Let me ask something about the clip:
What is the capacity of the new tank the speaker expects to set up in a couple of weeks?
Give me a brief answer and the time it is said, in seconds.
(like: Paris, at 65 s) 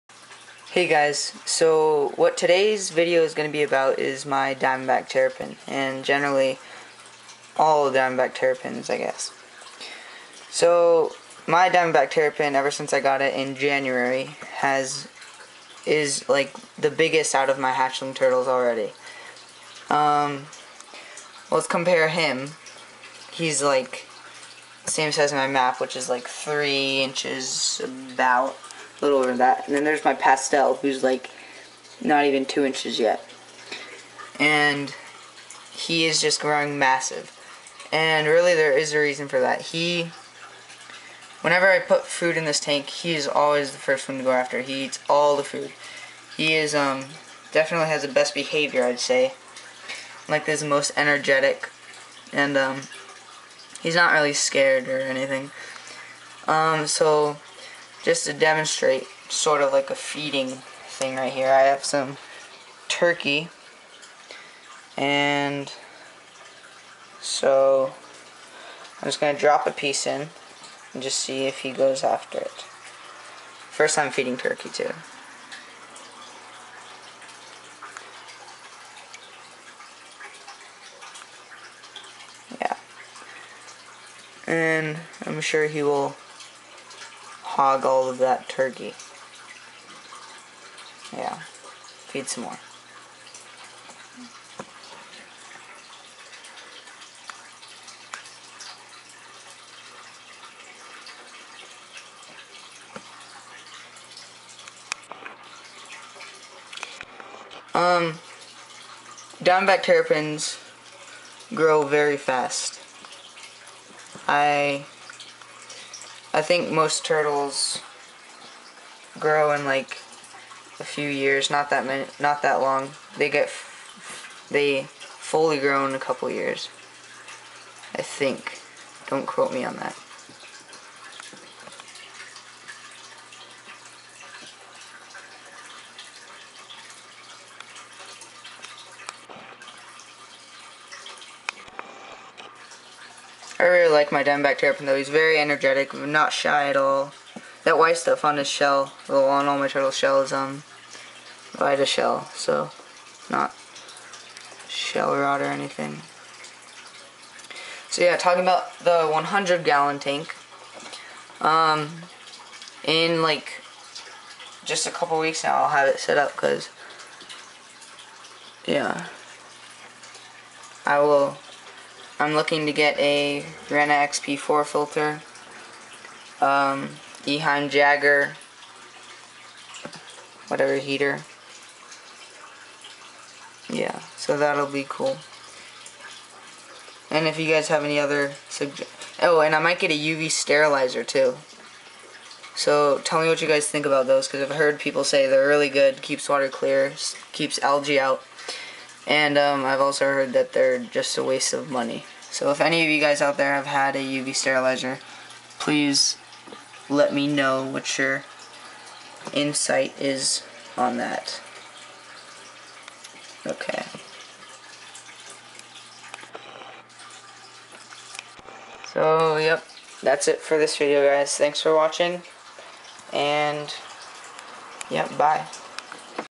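100 gallons, at 159 s.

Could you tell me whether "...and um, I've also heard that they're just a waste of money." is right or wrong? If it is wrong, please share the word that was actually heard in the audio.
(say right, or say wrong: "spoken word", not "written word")
right.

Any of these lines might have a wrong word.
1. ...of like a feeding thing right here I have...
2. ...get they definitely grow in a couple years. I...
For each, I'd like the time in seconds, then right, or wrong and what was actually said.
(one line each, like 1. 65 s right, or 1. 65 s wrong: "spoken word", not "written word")
1. 59 s right
2. 123 s wrong: "fully", not "definitely".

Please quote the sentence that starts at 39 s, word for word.
He, whenever I put food in this tank, he is always the first one to go after.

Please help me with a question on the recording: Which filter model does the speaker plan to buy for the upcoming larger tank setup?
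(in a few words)
Rena XP4.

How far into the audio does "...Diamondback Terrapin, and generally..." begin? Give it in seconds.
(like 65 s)
4 s.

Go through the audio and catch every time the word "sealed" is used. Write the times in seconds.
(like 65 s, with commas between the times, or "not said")
not said.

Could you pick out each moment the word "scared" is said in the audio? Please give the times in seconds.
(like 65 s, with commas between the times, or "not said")
54 s.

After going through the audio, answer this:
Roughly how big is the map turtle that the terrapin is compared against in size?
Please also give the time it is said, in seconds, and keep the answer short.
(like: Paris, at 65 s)
3 inches, at 26 s.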